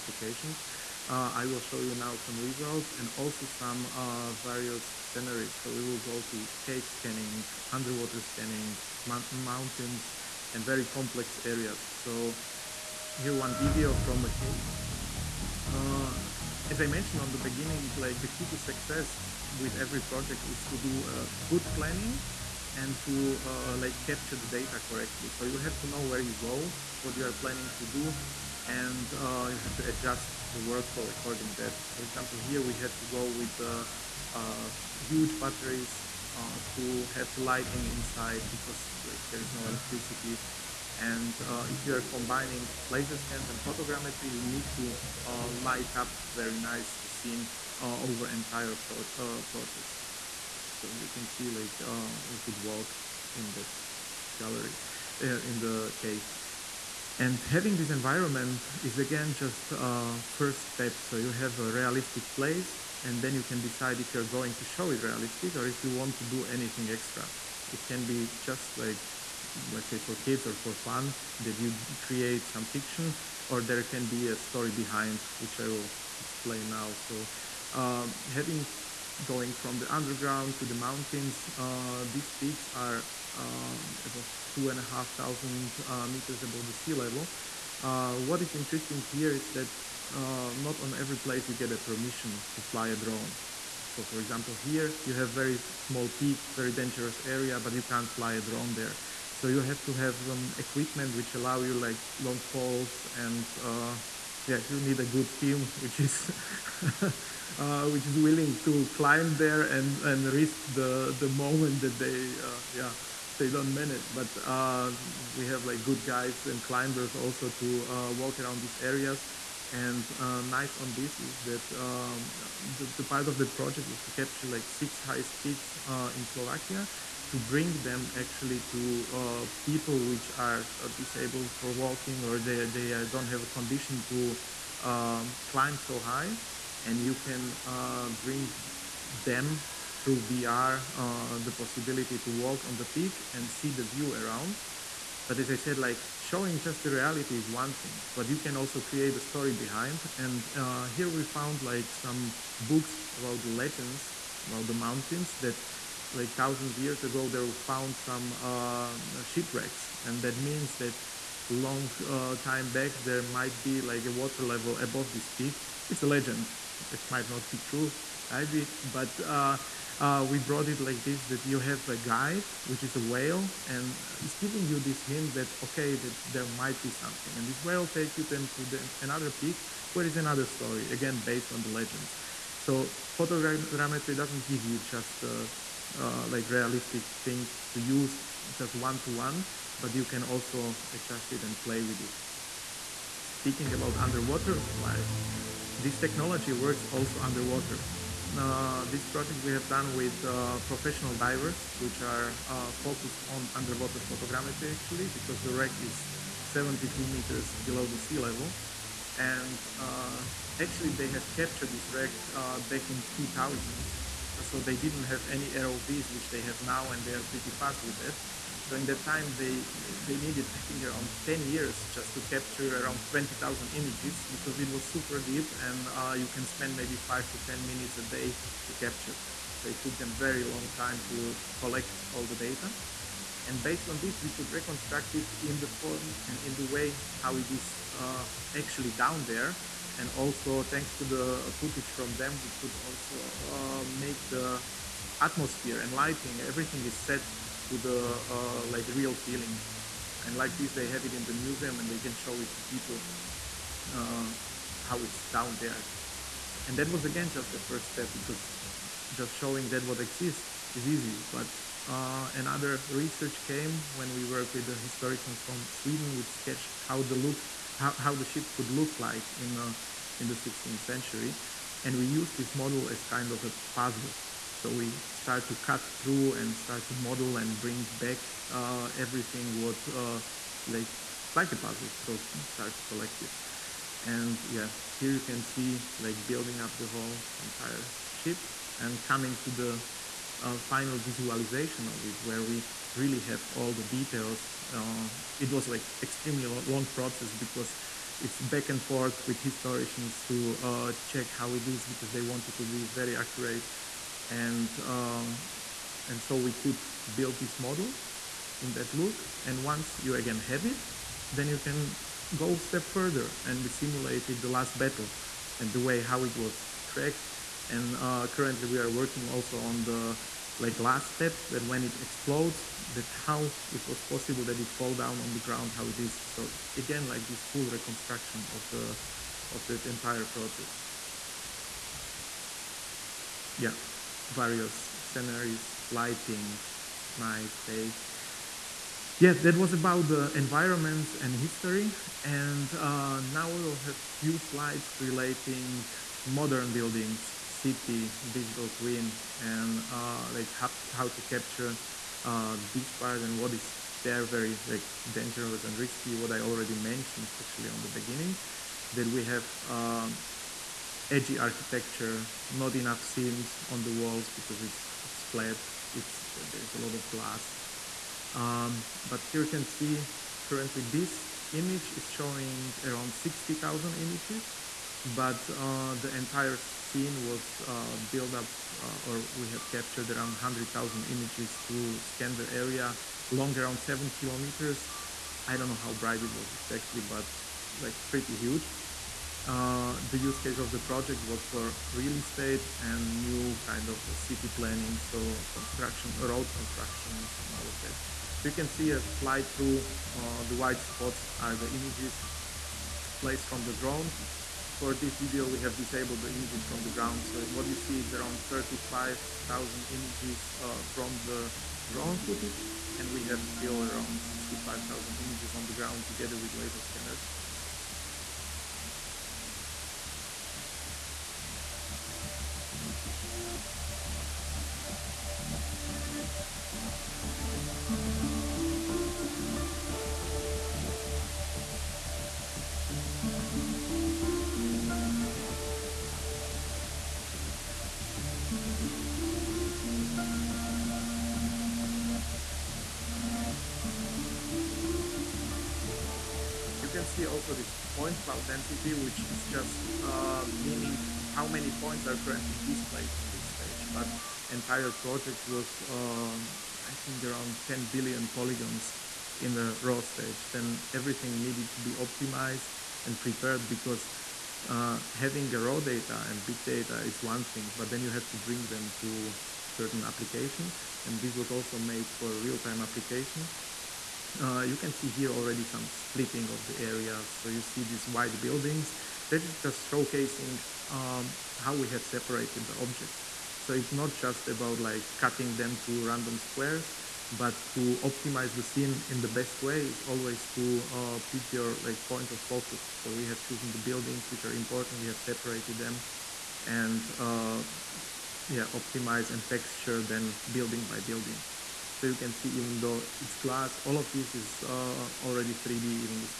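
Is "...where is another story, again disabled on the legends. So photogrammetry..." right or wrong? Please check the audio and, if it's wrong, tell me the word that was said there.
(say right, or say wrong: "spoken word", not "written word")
wrong: "based", not "disabled".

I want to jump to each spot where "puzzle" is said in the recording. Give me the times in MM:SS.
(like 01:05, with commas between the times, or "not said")
04:33, 04:41.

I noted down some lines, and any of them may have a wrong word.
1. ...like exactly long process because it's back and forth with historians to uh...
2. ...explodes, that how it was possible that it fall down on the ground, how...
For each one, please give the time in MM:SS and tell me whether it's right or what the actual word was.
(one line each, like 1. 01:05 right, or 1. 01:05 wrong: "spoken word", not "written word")
1. 04:55 wrong: "extremely", not "exactly"
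2. 05:21 right.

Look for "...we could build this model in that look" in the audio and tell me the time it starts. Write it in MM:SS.
05:06.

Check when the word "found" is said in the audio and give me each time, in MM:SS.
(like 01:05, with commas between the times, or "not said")
02:31, 02:37.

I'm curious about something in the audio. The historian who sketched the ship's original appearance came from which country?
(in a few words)
Sweden.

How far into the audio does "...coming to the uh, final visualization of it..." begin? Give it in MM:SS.
04:49.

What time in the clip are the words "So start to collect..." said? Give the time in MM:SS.
04:41.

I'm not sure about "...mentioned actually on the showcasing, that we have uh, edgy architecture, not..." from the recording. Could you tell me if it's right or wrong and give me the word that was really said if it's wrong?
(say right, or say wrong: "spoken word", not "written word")
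wrong: "beginning", not "showcasing".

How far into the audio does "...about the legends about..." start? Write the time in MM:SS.
02:33.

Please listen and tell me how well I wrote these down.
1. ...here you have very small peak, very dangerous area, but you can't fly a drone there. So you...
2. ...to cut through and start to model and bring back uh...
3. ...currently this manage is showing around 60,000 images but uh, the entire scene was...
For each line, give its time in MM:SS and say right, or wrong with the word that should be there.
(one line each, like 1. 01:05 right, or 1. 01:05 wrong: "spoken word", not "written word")
1. 01:34 right
2. 04:35 right
3. 06:10 wrong: "image", not "manage".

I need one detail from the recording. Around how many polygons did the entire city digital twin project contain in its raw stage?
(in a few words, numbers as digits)
10 billion.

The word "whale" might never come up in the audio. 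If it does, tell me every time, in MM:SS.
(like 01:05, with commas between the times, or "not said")
02:52, 02:57.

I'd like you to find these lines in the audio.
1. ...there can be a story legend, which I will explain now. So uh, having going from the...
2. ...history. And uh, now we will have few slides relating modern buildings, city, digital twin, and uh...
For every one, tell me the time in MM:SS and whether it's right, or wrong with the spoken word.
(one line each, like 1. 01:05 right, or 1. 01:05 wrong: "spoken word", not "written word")
1. 01:13 wrong: "behind", not "legend"
2. 05:41 right.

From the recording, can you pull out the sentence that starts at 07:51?
And this was also made for real-time application.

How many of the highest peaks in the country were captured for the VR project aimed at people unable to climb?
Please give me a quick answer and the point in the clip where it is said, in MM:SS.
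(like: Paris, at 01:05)
6, at 02:04.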